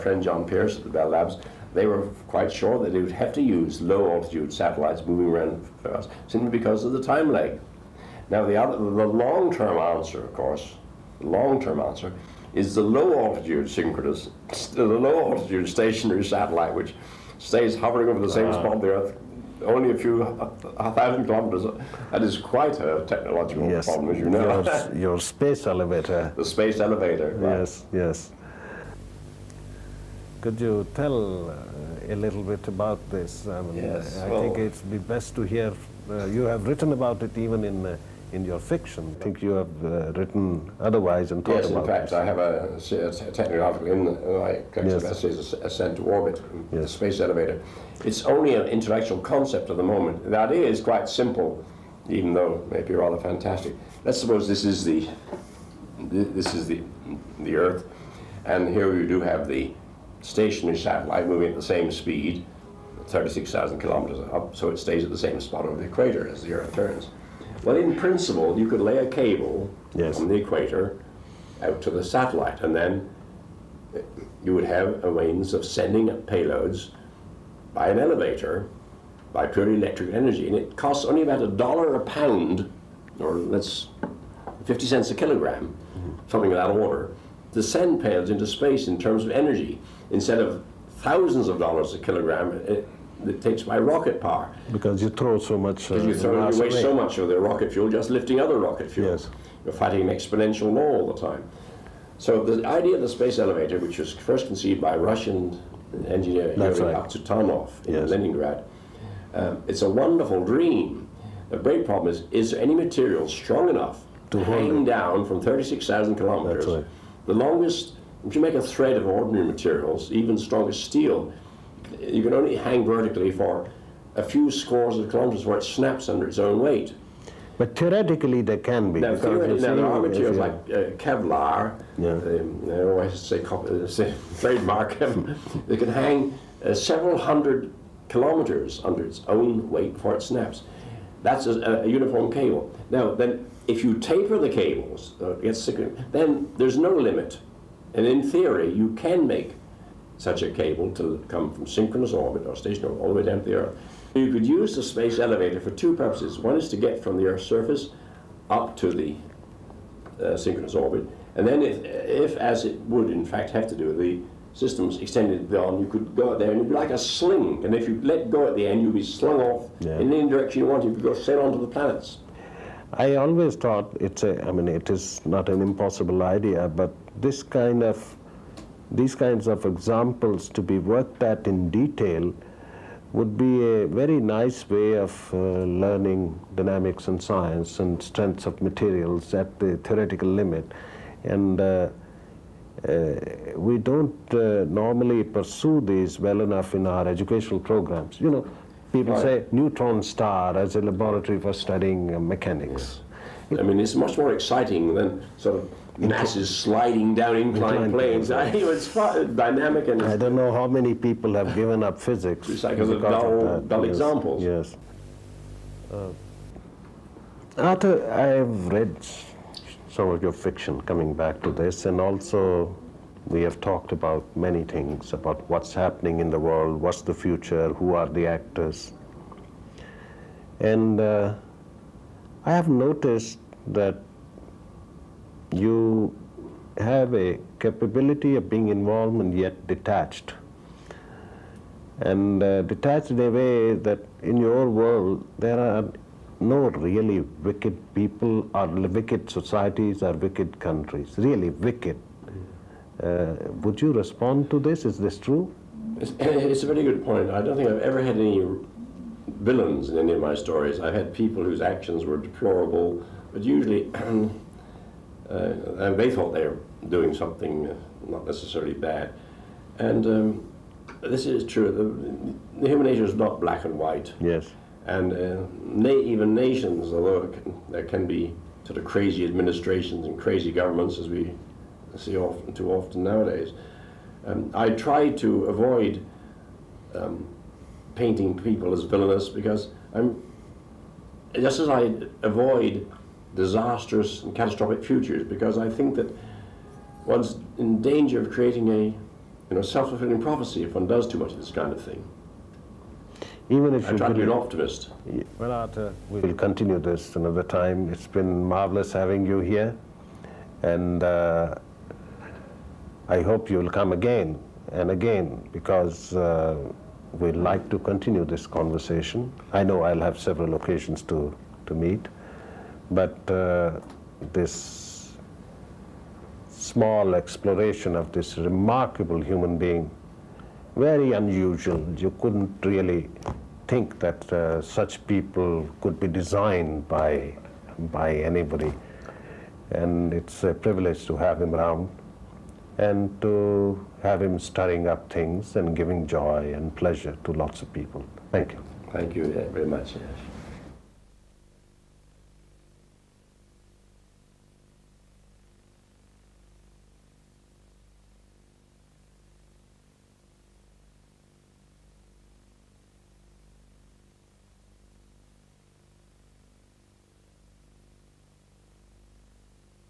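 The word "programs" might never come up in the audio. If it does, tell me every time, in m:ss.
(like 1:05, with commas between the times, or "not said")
3:17.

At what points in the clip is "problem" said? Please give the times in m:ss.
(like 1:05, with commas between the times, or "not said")
0:23, 1:51.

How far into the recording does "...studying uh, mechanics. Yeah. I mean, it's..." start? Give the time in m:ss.
3:21.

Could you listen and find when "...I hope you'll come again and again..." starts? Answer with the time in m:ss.
5:13.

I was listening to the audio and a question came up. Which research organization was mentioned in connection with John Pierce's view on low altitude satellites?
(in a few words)
Bell Labs.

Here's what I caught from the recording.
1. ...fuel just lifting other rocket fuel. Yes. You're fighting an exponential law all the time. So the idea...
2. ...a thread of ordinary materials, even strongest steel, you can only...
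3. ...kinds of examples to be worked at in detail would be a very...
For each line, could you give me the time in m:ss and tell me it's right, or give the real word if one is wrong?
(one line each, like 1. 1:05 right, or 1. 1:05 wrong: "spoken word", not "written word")
1. 1:37 right
2. 1:58 right
3. 2:59 right.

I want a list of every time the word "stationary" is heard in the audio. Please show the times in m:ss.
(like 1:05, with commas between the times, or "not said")
0:15, 1:00, 2:32.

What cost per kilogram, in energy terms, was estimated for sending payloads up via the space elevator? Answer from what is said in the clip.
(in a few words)
50 cents.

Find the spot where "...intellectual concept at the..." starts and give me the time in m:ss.
0:48.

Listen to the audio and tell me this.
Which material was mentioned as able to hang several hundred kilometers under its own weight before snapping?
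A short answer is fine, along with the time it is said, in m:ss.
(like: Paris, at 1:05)
Kevlar, at 2:10.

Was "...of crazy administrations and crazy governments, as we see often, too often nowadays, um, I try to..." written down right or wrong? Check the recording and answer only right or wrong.
right.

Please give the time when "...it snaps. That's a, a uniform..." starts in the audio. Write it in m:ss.
2:20.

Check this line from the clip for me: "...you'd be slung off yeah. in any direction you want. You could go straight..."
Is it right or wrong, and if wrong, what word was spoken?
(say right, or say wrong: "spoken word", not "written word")
right.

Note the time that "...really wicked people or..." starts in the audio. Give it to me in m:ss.
4:06.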